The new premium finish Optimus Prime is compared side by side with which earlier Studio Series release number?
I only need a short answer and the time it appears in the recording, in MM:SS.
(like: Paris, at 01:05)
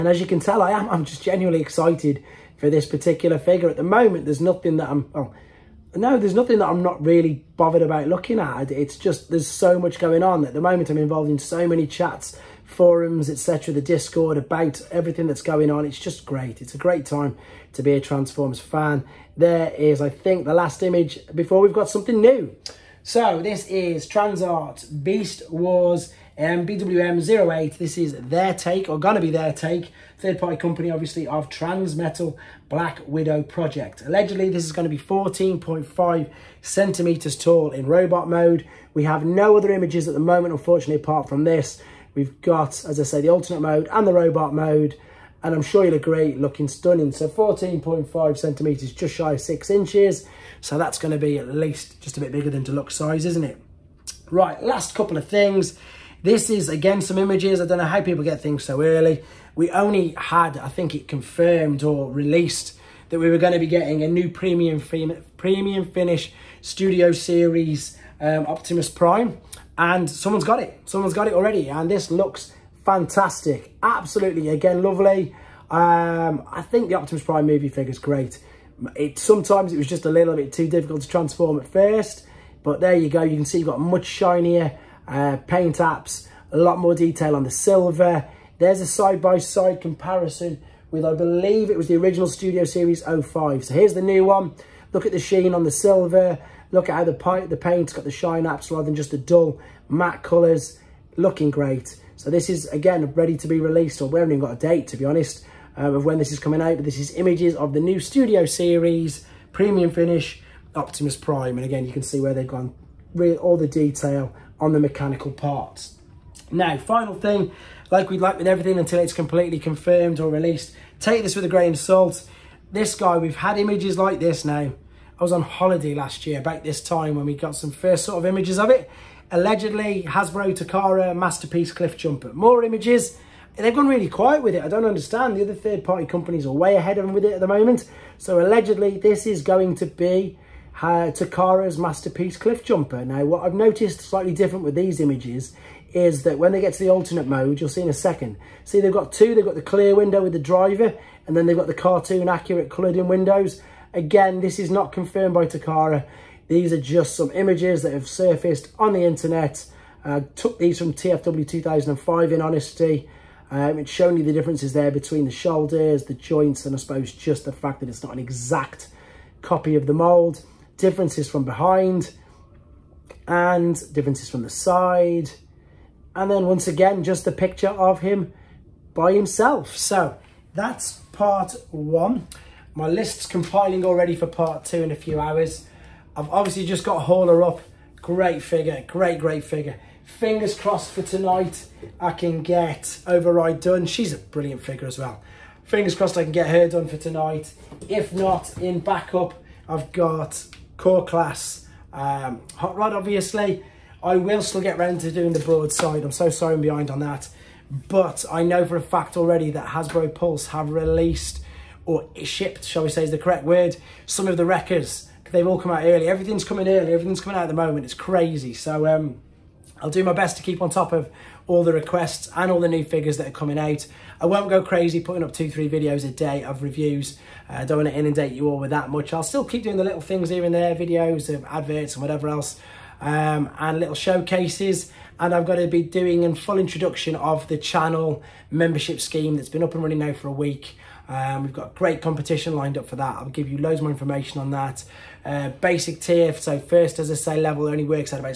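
05, at 01:33.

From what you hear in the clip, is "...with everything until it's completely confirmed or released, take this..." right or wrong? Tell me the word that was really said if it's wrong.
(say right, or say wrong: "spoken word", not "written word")
right.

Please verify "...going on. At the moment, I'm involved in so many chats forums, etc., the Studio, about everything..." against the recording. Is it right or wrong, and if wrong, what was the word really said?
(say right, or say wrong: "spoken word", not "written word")
wrong: "Discord", not "Studio".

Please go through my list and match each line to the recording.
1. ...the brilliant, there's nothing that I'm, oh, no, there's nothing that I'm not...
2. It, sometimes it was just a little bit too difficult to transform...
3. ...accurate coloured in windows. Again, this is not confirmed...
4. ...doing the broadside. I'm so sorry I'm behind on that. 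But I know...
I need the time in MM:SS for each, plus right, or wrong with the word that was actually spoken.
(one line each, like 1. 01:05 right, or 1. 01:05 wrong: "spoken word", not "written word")
1. 00:03 wrong: "moment", not "brilliant"
2. 01:18 right
3. 02:32 right
4. 03:25 right.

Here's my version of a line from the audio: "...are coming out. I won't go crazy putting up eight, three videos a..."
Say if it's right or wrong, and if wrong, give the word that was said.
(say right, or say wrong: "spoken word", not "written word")
wrong: "two", not "eight".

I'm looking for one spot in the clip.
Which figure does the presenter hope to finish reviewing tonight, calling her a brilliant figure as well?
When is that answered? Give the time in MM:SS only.
03:13.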